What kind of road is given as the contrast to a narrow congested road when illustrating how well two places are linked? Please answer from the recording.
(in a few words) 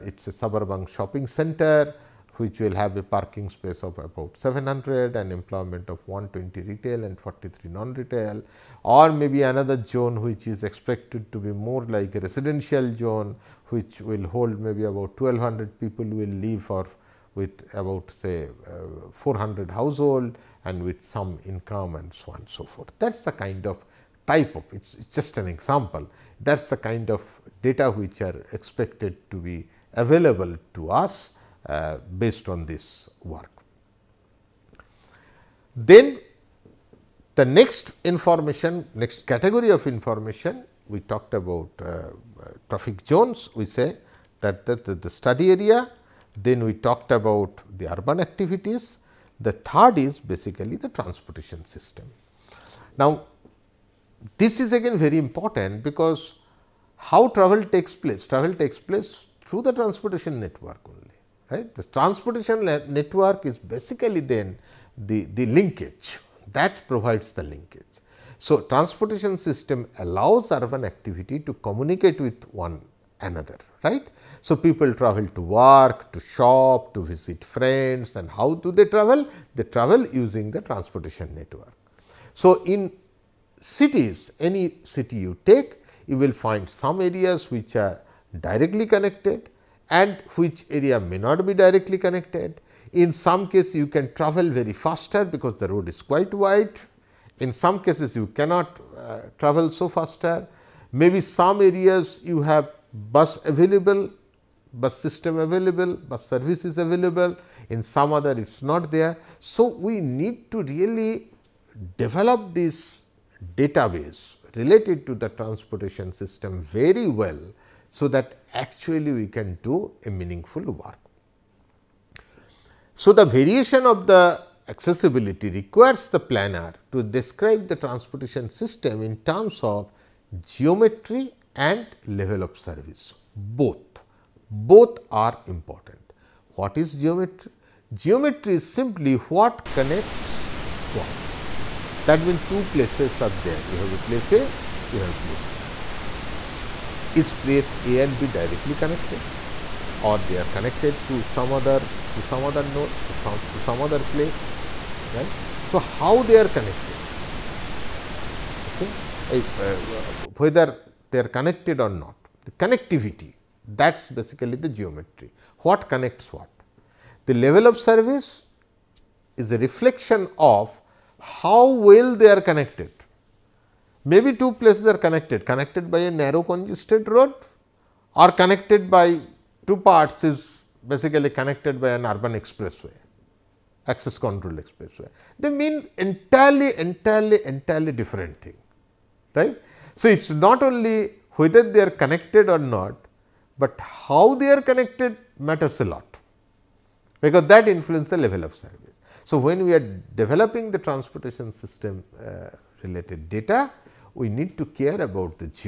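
Urban expressway.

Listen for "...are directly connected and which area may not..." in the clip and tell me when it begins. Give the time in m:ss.
1:27.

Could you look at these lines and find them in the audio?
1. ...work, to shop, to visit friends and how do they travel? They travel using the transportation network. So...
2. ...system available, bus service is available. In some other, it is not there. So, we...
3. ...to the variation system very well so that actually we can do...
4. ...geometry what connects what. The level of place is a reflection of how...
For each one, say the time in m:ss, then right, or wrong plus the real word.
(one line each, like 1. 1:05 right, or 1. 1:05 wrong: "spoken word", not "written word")
1. 1:15 right
2. 1:44 right
3. 1:55 wrong: "transportation", not "variation"
4. 2:44 wrong: "service", not "place".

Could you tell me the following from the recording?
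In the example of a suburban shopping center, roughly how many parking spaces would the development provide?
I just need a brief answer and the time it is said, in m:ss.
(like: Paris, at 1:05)
700, at 0:04.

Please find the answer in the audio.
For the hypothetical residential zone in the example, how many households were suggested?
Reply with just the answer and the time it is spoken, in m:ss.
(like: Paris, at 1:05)
400, at 0:19.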